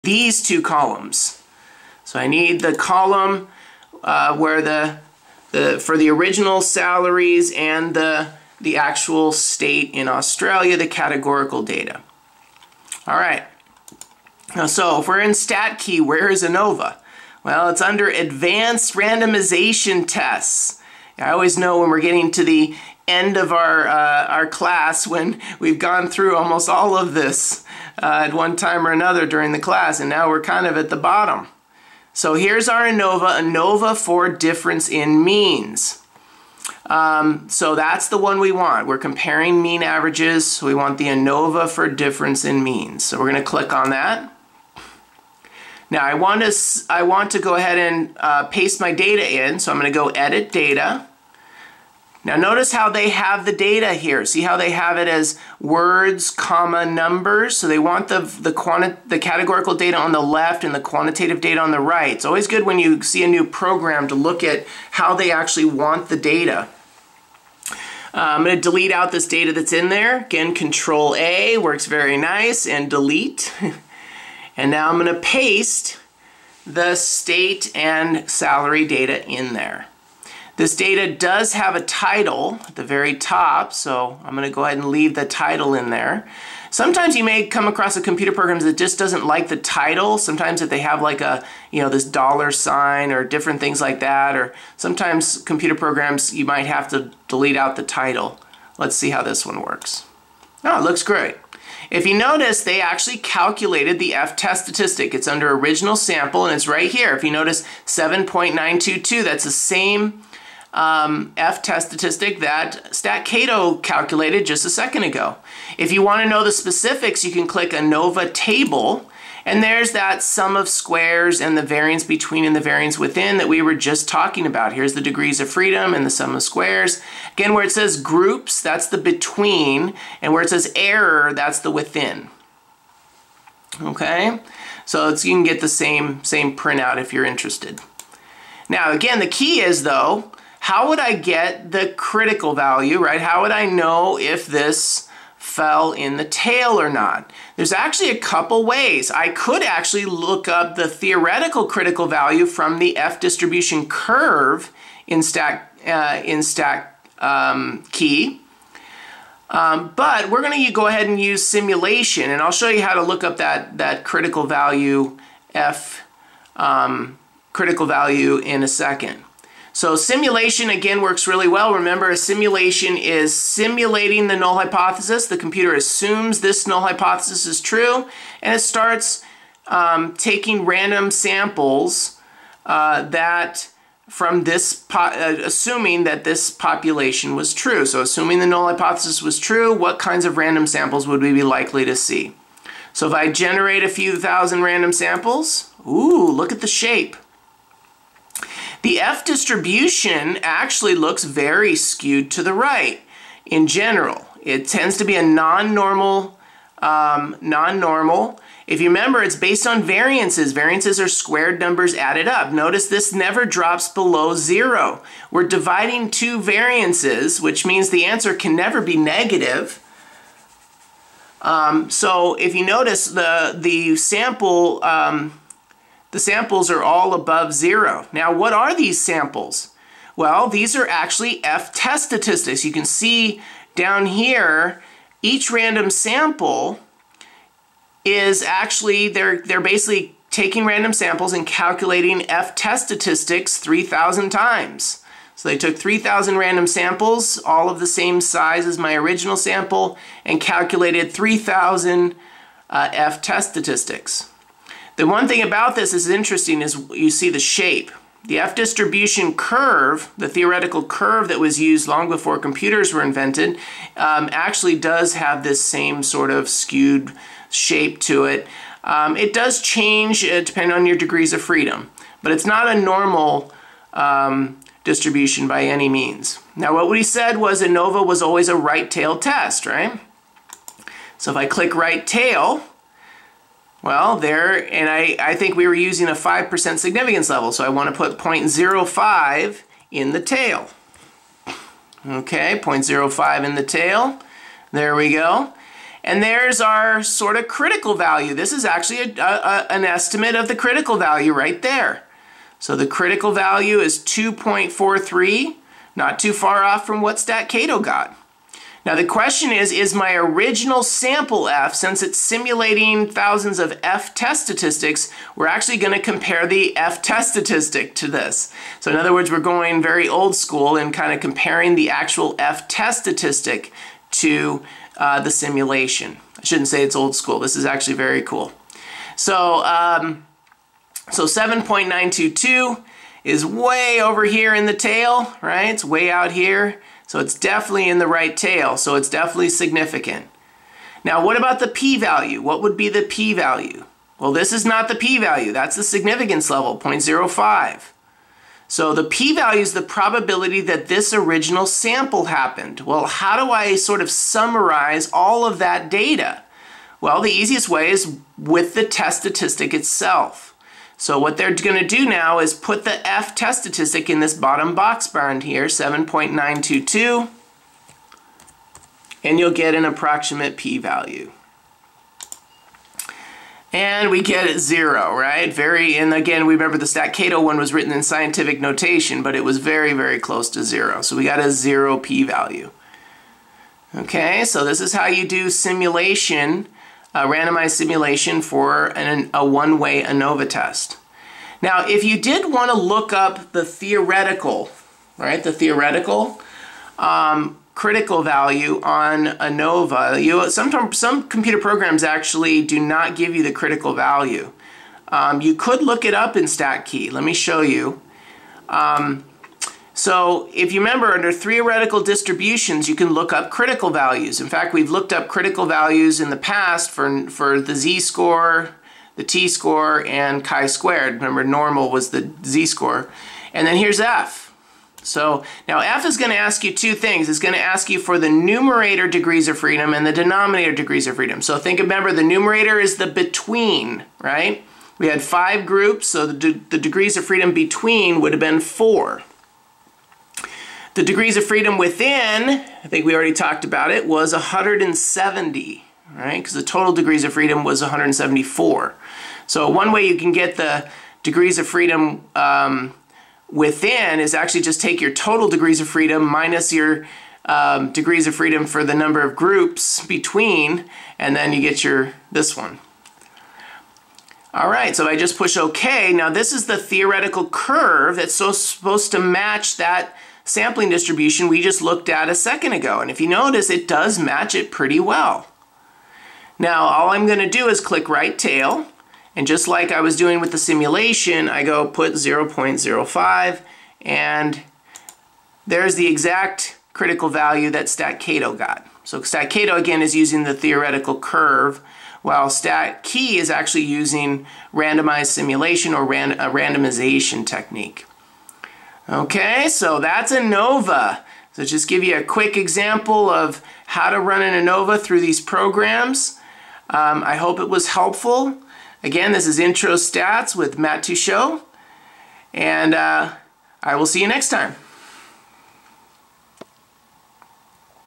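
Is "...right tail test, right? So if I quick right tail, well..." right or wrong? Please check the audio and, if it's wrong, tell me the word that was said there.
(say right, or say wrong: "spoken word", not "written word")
wrong: "click", not "quick".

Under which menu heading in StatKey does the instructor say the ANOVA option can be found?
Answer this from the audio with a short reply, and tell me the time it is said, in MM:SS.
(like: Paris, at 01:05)
Advanced Randomization Tests, at 00:18.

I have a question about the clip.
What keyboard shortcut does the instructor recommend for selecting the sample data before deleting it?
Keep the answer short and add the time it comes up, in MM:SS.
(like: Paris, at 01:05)
Control A, at 01:10.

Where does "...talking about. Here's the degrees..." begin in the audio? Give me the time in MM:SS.
02:04.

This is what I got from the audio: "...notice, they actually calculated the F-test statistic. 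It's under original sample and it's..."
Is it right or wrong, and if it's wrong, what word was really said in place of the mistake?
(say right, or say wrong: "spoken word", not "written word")
right.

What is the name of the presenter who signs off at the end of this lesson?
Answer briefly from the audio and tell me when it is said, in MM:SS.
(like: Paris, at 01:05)
Matt Teachout, at 08:30.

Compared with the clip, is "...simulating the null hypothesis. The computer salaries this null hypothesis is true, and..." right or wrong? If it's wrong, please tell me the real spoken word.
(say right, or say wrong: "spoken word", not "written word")
wrong: "assumes", not "salaries".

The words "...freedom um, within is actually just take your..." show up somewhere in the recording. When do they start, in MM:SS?
07:31.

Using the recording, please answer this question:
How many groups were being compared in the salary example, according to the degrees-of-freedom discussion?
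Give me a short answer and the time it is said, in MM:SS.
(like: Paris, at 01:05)
5, at 07:15.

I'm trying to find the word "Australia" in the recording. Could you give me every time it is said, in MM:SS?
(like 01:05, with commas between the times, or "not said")
00:10.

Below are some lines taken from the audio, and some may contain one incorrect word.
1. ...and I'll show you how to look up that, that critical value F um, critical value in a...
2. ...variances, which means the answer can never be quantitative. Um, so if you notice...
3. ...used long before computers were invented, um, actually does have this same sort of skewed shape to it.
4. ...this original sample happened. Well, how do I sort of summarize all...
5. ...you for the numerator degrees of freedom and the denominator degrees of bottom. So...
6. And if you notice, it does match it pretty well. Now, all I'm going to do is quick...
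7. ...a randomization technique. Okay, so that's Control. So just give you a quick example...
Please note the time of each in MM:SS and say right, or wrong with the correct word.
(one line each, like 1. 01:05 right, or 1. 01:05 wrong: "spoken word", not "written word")
1. 02:42 right
2. 03:36 wrong: "negative", not "quantitative"
3. 04:21 right
4. 05:50 right
5. 07:07 wrong: "freedom", not "bottom"
6. 07:52 wrong: "click", not "quick"
7. 08:16 wrong: "ANOVA", not "Control".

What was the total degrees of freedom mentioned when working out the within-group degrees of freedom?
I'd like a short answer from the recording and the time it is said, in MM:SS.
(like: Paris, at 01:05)
174, at 07:27.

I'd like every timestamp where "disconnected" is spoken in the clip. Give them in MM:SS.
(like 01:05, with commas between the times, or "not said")
not said.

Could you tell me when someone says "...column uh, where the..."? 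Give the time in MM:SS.
00:02.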